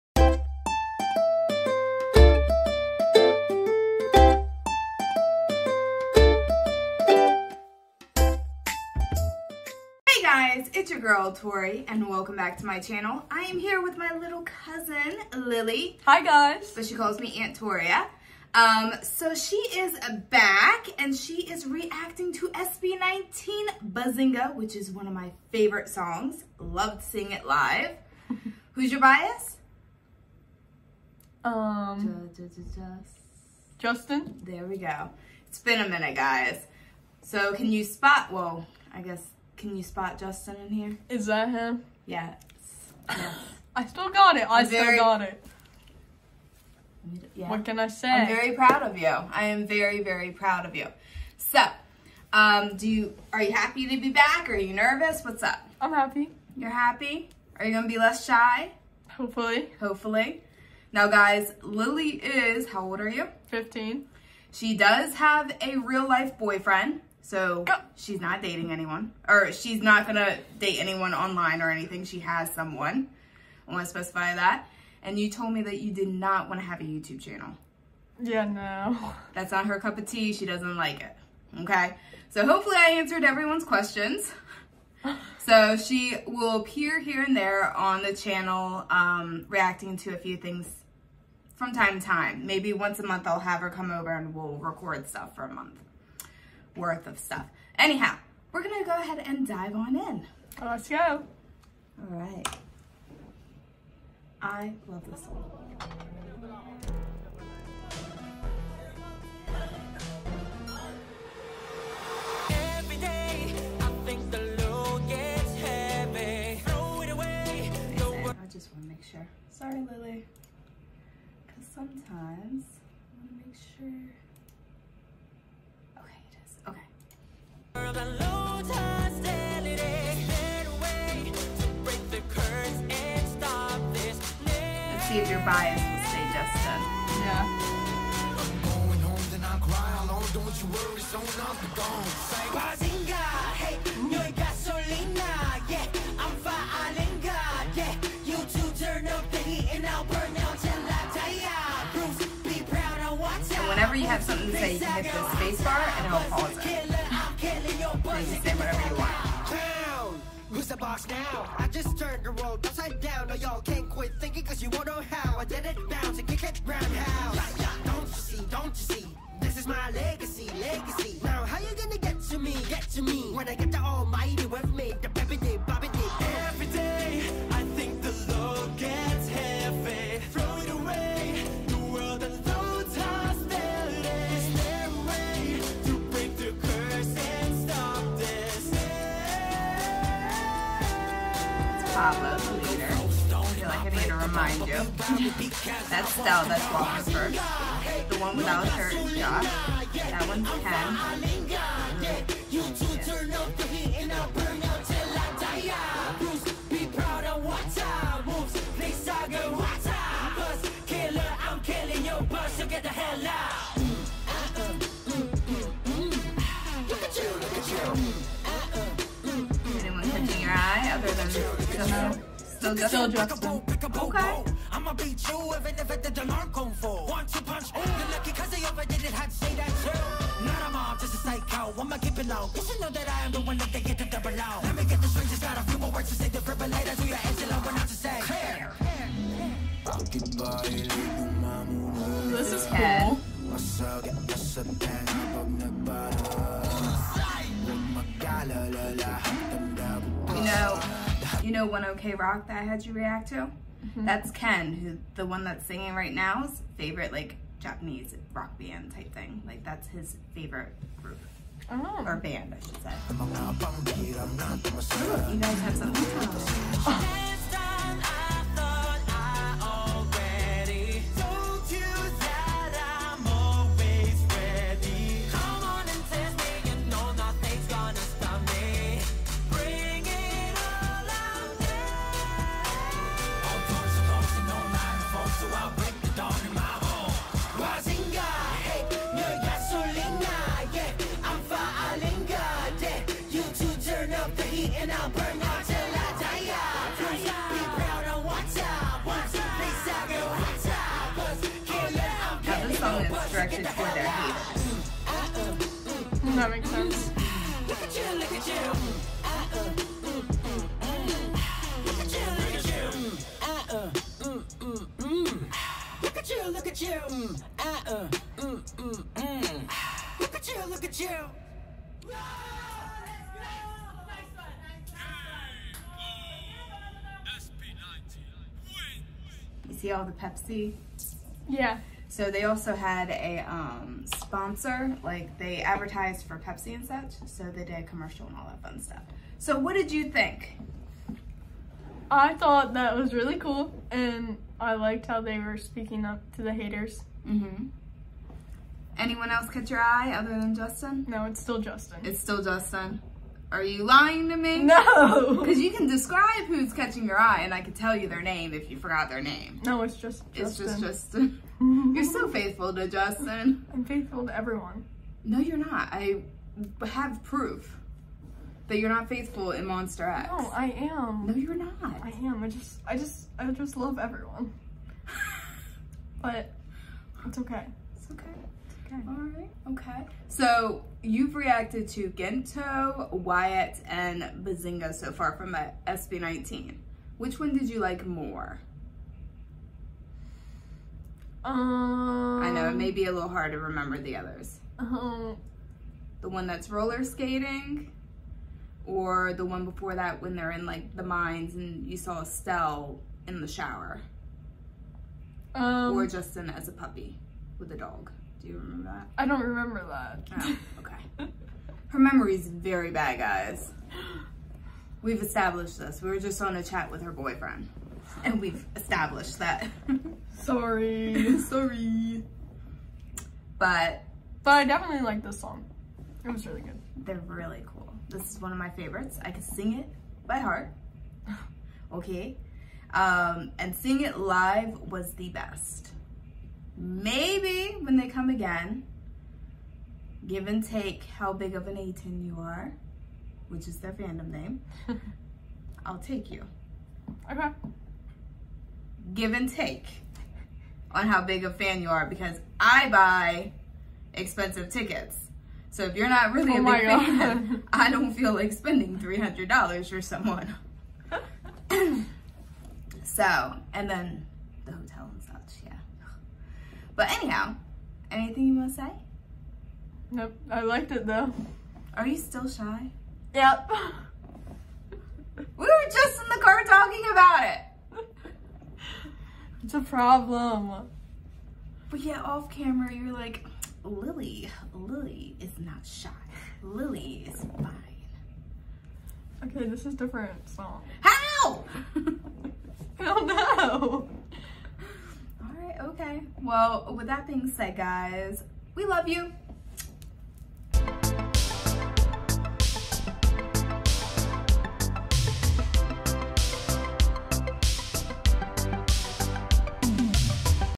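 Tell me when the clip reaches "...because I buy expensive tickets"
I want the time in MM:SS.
07:32.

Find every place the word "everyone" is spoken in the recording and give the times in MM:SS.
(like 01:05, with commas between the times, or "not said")
01:23, 06:04, 06:13.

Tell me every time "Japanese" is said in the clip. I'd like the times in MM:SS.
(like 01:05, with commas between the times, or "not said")
04:17.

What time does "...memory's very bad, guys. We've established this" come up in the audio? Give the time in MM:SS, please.
06:51.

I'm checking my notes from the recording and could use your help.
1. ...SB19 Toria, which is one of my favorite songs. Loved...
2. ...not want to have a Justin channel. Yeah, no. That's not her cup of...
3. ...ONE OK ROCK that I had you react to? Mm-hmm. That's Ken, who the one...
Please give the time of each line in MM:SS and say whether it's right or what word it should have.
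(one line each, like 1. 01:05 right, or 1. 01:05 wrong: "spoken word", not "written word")
1. 00:22 wrong: "Bazinga", not "Toria"
2. 01:16 wrong: "YouTube", not "Justin"
3. 04:11 right.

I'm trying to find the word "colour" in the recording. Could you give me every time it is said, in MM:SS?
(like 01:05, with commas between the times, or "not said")
not said.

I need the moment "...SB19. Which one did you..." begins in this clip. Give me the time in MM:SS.
06:25.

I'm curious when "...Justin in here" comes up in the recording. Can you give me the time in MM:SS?
00:40.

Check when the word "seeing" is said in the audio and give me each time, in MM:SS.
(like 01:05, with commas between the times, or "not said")
00:27, 07:13.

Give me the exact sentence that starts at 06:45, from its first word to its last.
Um, or Justin as a puppy with a dog.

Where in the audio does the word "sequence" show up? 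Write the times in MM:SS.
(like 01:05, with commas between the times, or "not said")
not said.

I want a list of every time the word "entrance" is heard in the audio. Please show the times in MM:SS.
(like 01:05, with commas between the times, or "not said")
not said.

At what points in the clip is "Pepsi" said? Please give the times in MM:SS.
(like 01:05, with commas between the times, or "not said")
05:30, 05:36.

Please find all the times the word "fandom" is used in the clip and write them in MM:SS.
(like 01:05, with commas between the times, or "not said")
07:23.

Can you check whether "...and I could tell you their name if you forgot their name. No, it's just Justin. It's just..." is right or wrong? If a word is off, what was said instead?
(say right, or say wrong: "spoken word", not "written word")
right.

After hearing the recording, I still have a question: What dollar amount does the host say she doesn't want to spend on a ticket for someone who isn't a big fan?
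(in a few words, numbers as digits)
$300.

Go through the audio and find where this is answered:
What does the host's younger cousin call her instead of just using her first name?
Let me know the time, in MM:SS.
00:17.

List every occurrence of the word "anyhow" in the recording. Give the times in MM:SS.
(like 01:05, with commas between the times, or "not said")
01:37, 07:47.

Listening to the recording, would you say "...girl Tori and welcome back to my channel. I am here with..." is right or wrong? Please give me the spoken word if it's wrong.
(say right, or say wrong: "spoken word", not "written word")
right.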